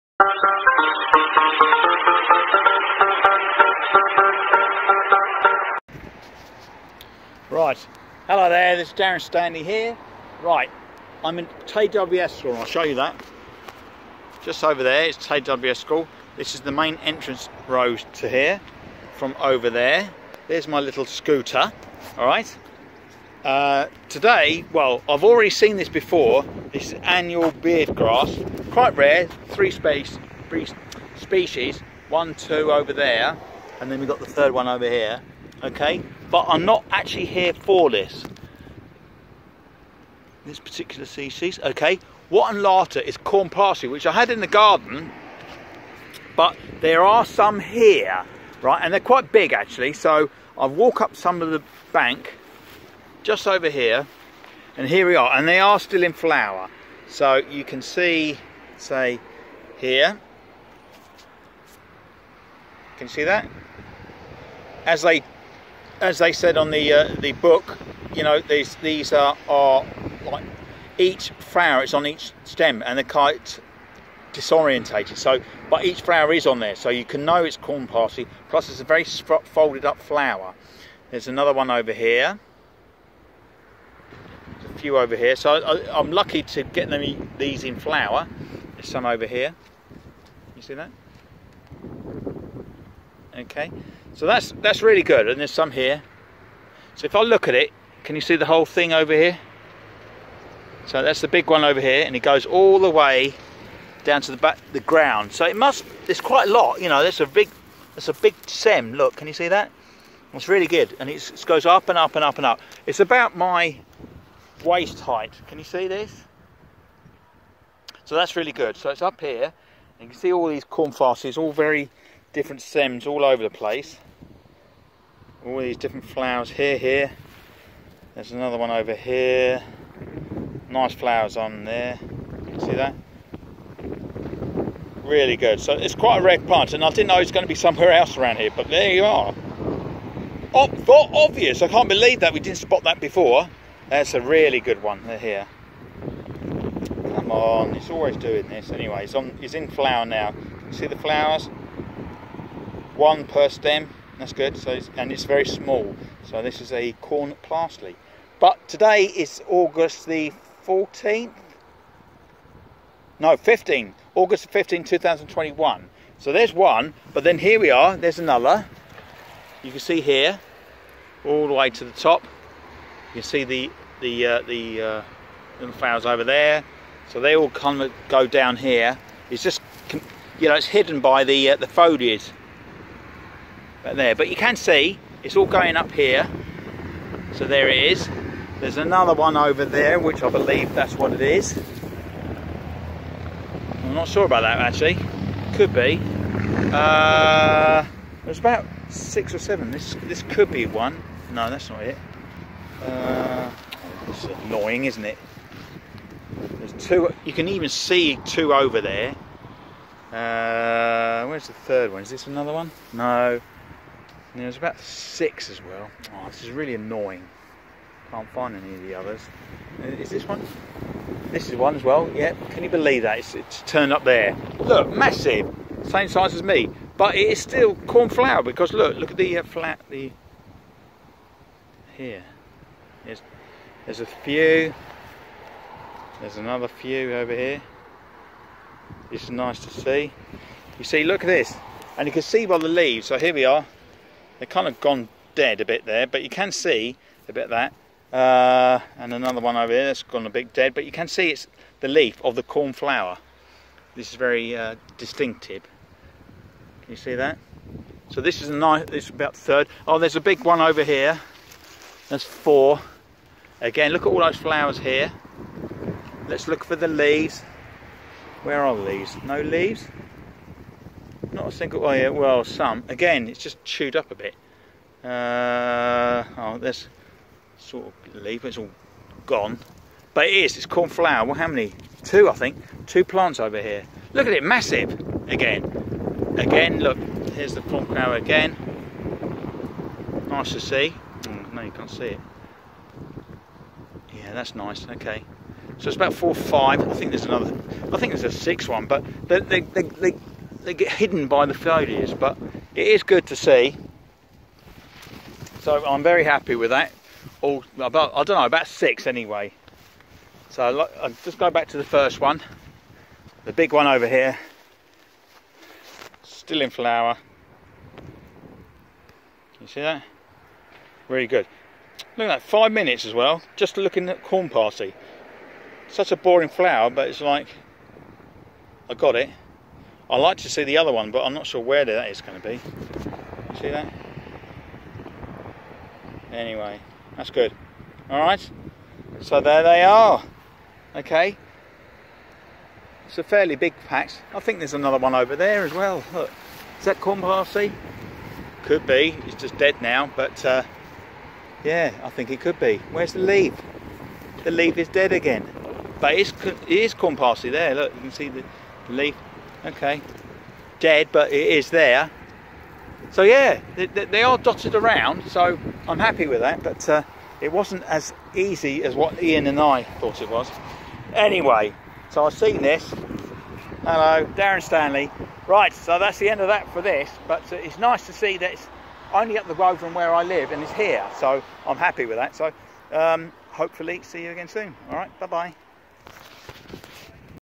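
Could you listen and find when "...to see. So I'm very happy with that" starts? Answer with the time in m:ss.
5:03.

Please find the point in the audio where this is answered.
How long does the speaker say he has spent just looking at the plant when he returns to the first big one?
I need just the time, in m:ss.
5:22.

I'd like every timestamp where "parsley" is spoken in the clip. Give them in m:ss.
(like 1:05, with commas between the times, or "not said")
0:43, 1:17, 2:00, 2:37, 5:24, 5:47, 5:57.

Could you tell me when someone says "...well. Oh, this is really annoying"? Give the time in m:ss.
3:35.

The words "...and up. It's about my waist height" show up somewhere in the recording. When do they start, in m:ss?
1:52.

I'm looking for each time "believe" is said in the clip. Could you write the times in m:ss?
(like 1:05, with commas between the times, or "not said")
2:21, 3:10, 3:42.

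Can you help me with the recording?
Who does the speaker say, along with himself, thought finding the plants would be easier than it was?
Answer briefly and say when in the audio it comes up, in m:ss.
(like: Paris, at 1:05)
Ian, at 6:09.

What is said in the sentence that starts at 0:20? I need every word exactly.
There's my little scooter, all right?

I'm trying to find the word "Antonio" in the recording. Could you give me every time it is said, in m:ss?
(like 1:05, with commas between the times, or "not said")
not said.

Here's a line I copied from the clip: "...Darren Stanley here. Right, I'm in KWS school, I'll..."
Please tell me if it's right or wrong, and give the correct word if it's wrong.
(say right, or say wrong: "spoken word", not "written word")
right.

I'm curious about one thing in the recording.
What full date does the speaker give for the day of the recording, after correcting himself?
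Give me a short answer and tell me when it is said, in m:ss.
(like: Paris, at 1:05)
August 15, 2021, at 2:44.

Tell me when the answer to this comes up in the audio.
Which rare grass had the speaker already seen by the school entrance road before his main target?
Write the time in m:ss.
0:27.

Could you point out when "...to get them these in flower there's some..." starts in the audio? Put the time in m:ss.
1:26.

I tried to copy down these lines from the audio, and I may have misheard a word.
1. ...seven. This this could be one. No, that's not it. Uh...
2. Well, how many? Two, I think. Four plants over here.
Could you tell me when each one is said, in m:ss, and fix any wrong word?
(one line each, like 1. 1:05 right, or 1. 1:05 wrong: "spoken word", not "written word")
1. 3:19 right
2. 4:41 wrong: "Two", not "Four".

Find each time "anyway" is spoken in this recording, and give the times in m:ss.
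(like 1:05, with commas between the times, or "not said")
2:28, 5:09, 5:36, 6:11.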